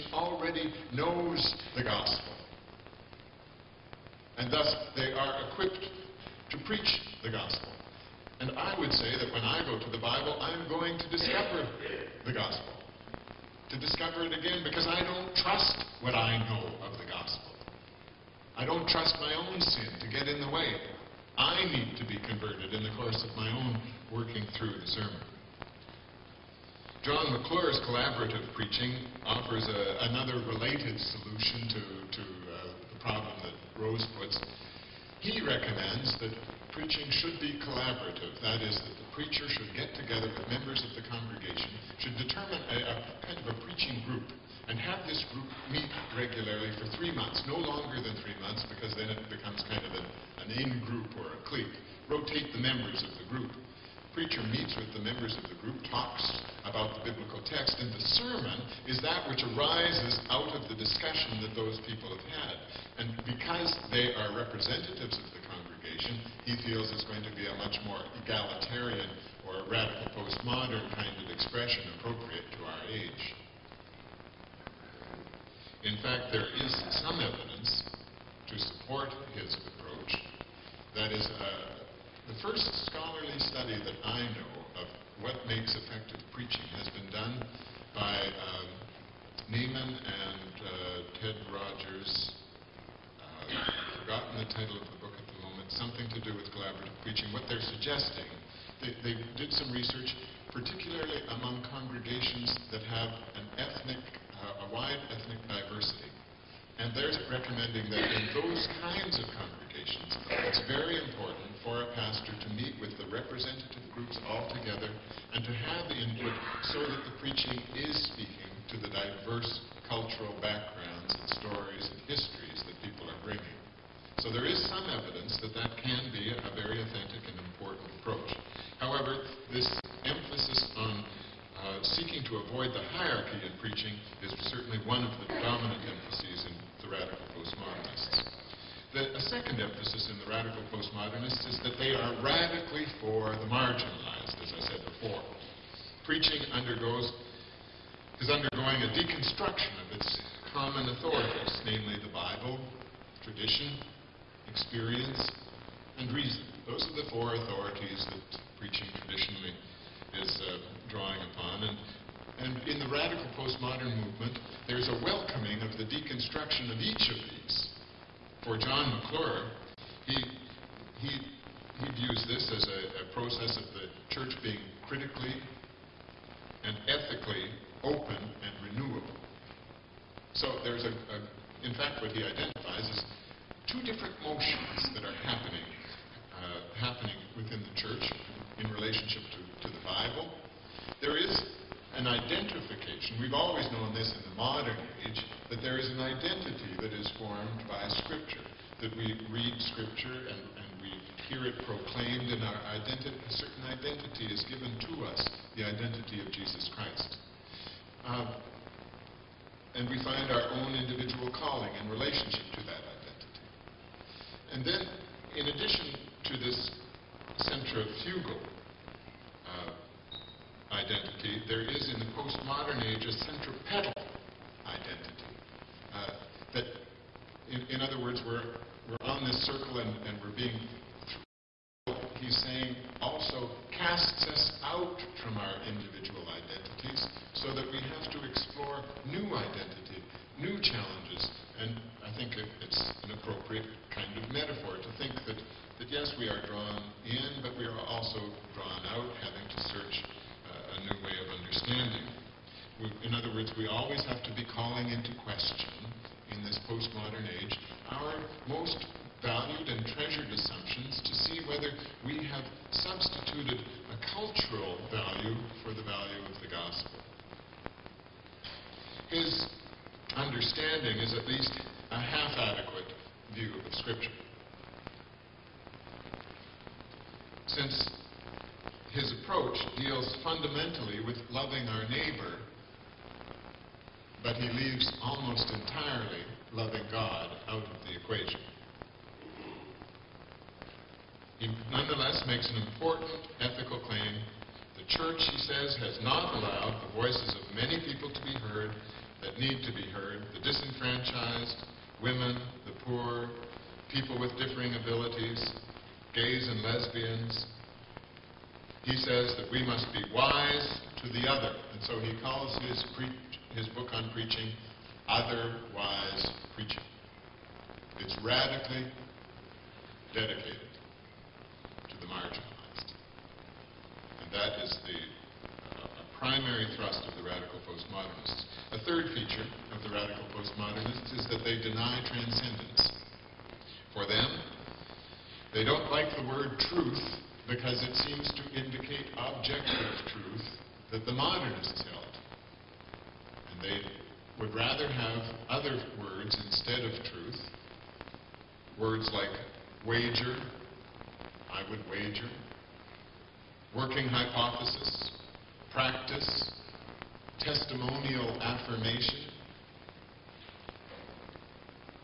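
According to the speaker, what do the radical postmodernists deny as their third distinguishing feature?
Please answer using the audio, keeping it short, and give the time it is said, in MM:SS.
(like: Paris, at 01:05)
transcendence, at 05:32.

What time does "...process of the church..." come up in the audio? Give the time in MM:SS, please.
02:53.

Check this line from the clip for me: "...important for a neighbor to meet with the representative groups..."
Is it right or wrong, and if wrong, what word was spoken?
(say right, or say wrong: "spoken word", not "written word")
wrong: "pastor", not "neighbor".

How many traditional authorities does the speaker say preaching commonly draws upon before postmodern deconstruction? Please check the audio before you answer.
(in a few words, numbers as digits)
4.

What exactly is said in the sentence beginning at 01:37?
What they're suggesting, they, they did some research, particularly among congregations that have an ethnic, uh, a wide ethnic diversity.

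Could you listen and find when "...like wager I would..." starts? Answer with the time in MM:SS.
05:49.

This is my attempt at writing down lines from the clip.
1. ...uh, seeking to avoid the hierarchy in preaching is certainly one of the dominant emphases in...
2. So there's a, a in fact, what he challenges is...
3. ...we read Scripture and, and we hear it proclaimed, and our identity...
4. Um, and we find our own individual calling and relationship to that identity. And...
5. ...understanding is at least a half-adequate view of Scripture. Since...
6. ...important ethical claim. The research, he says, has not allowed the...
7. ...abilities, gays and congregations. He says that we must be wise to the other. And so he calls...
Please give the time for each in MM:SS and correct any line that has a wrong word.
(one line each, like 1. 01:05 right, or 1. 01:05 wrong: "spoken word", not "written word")
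1. 02:11 right
2. 03:00 wrong: "identifies", not "challenges"
3. 03:18 right
4. 03:28 right
5. 04:30 right
6. 04:52 wrong: "church", not "research"
7. 05:04 wrong: "lesbians", not "congregations".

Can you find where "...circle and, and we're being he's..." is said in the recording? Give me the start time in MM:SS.
03:49.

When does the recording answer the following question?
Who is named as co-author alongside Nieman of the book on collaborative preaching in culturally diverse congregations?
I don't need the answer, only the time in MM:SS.
01:31.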